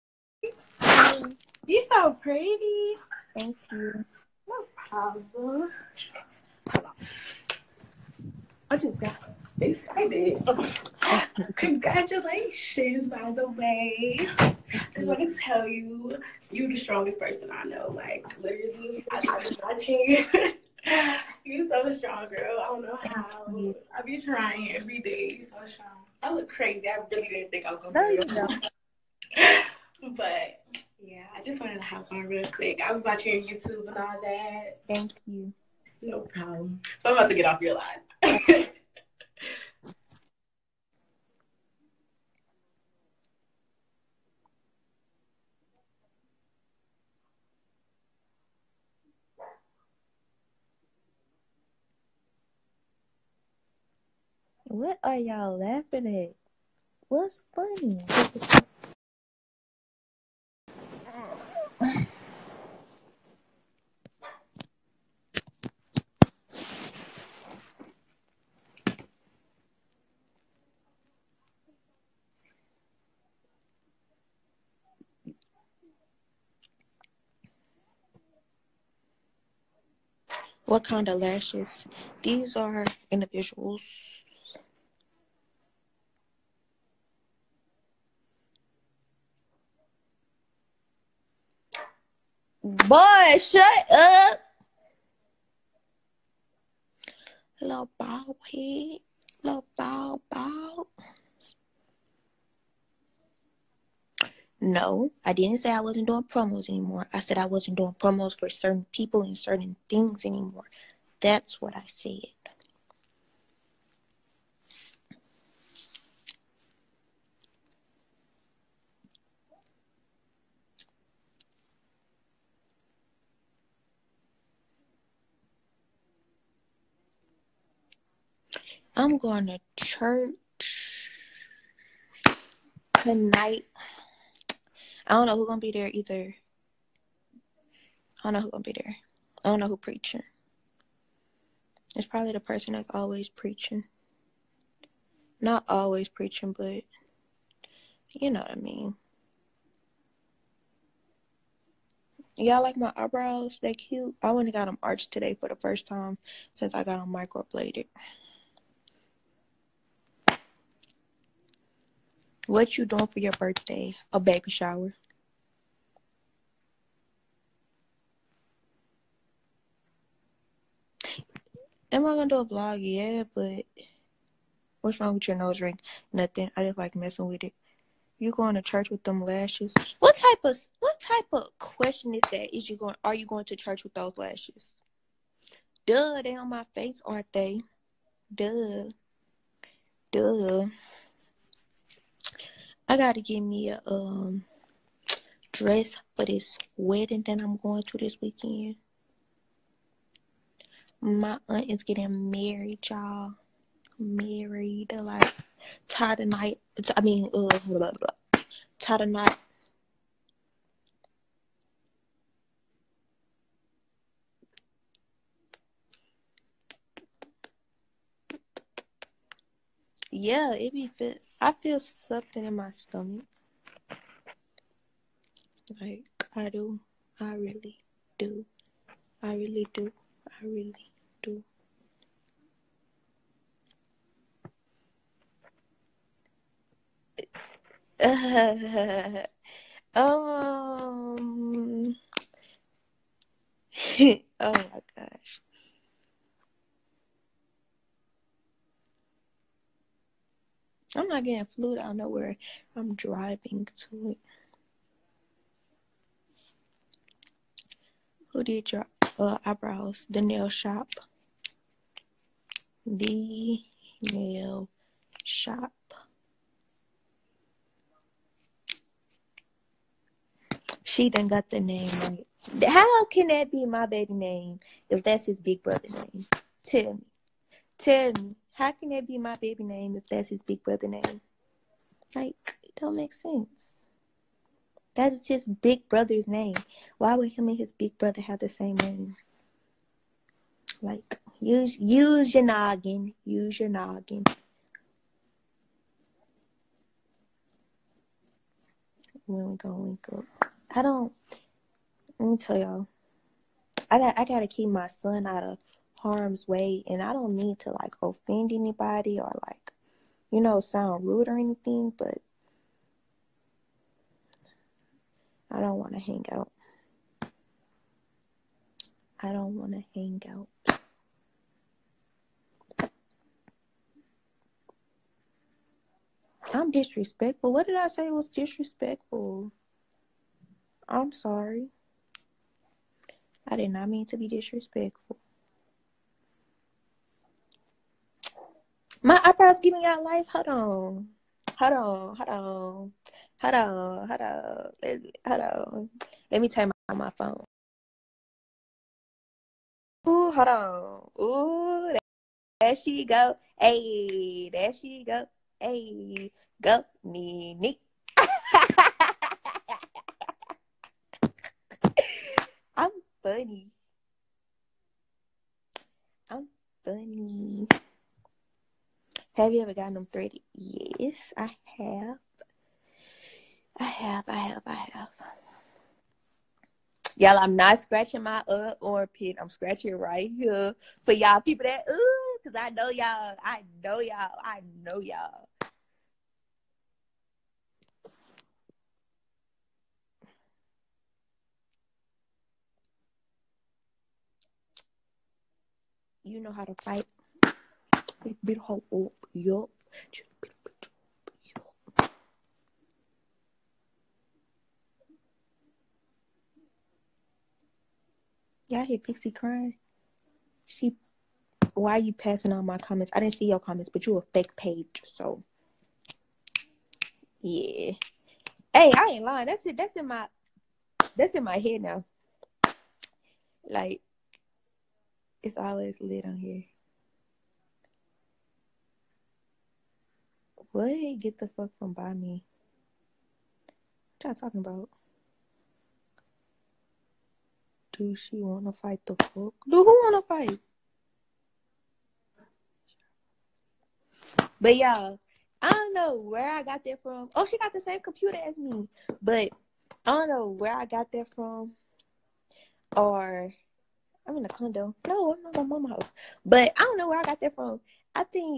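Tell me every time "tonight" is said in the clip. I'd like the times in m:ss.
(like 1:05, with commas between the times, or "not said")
2:12, 3:26.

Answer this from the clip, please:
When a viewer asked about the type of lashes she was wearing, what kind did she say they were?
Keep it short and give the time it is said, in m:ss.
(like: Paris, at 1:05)
Individuals, at 1:23.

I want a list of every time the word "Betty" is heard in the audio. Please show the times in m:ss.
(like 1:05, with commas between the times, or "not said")
not said.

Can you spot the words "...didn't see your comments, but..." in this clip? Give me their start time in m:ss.
6:53.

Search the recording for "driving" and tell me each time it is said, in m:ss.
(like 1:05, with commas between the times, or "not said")
4:12.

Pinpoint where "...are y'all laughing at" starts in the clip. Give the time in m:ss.
0:55.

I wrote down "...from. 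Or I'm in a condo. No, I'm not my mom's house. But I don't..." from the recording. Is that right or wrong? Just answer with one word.
right.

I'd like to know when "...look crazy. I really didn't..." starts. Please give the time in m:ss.
0:26.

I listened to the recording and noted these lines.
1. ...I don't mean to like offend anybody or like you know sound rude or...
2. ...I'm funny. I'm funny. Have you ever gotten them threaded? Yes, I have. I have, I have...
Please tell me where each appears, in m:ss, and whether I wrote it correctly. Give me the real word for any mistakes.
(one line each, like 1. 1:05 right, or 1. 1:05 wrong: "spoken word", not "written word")
1. 5:07 right
2. 6:02 right.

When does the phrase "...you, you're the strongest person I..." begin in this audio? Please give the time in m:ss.
0:15.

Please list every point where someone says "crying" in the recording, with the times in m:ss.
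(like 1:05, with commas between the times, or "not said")
6:49.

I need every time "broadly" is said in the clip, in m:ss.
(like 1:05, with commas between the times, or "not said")
not said.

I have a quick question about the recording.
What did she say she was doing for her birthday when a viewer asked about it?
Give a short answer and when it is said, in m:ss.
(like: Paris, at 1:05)
A baby shower, at 2:44.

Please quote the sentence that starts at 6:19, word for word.
I'm scratching right here for y'all people that ooh, cause I know y'all, I know y'all, I know y'all.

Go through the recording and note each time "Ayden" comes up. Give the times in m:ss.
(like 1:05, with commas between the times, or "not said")
not said.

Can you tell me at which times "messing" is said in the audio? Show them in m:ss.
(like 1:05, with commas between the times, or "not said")
2:56.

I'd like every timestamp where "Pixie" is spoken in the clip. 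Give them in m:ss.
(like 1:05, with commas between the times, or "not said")
6:48.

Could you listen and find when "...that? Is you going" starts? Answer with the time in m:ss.
3:02.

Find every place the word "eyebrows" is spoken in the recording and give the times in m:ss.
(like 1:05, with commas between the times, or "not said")
2:32, 4:19, 5:39.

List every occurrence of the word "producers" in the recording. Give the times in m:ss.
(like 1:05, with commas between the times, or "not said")
not said.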